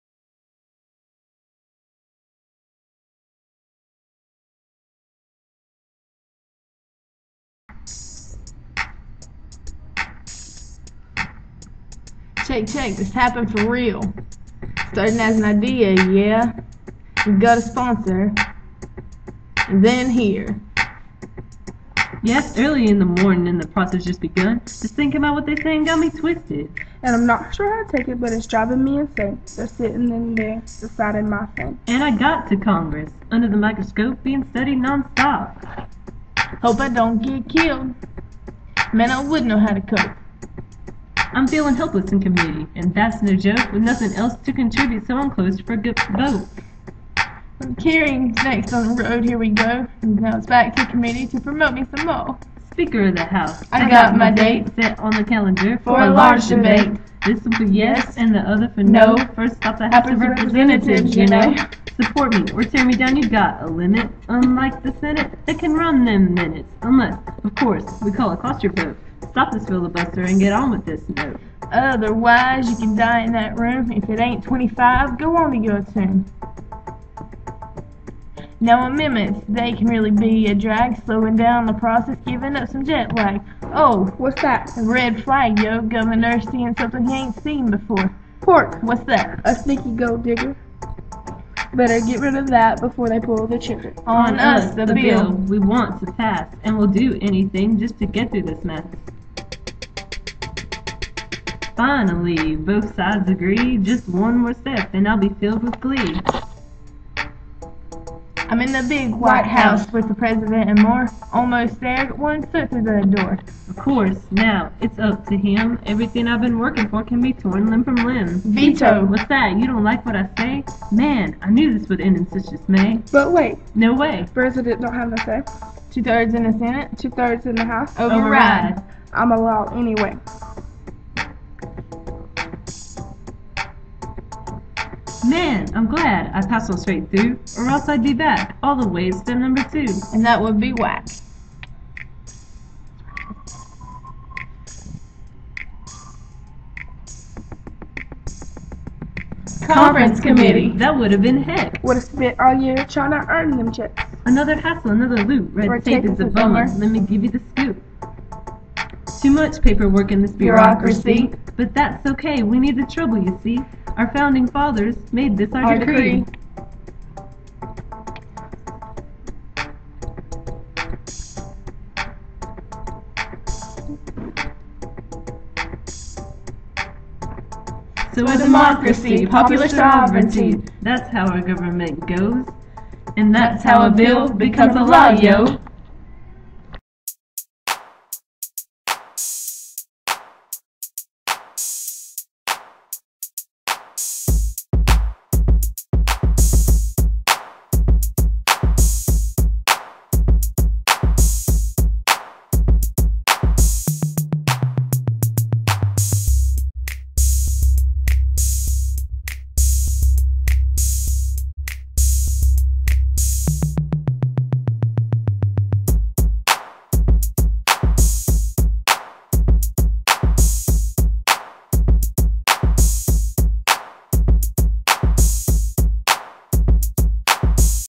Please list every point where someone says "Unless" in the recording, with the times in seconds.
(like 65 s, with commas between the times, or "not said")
66 s.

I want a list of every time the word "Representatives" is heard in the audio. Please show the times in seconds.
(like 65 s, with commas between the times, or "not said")
60 s.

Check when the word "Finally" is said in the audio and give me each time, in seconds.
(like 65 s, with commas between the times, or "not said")
101 s.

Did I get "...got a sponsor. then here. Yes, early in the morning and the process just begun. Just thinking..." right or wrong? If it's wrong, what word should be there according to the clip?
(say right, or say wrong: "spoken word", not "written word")
right.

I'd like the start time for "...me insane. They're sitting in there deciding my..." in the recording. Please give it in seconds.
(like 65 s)
28 s.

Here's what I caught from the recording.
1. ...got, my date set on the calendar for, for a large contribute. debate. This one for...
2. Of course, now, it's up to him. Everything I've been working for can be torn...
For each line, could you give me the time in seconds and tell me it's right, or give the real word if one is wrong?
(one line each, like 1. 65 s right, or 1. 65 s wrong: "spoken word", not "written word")
1. 54 s wrong: "debate", not "contribute"
2. 113 s right.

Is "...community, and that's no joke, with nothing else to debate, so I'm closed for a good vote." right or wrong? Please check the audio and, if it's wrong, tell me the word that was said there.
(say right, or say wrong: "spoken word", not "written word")
wrong: "contribute", not "debate".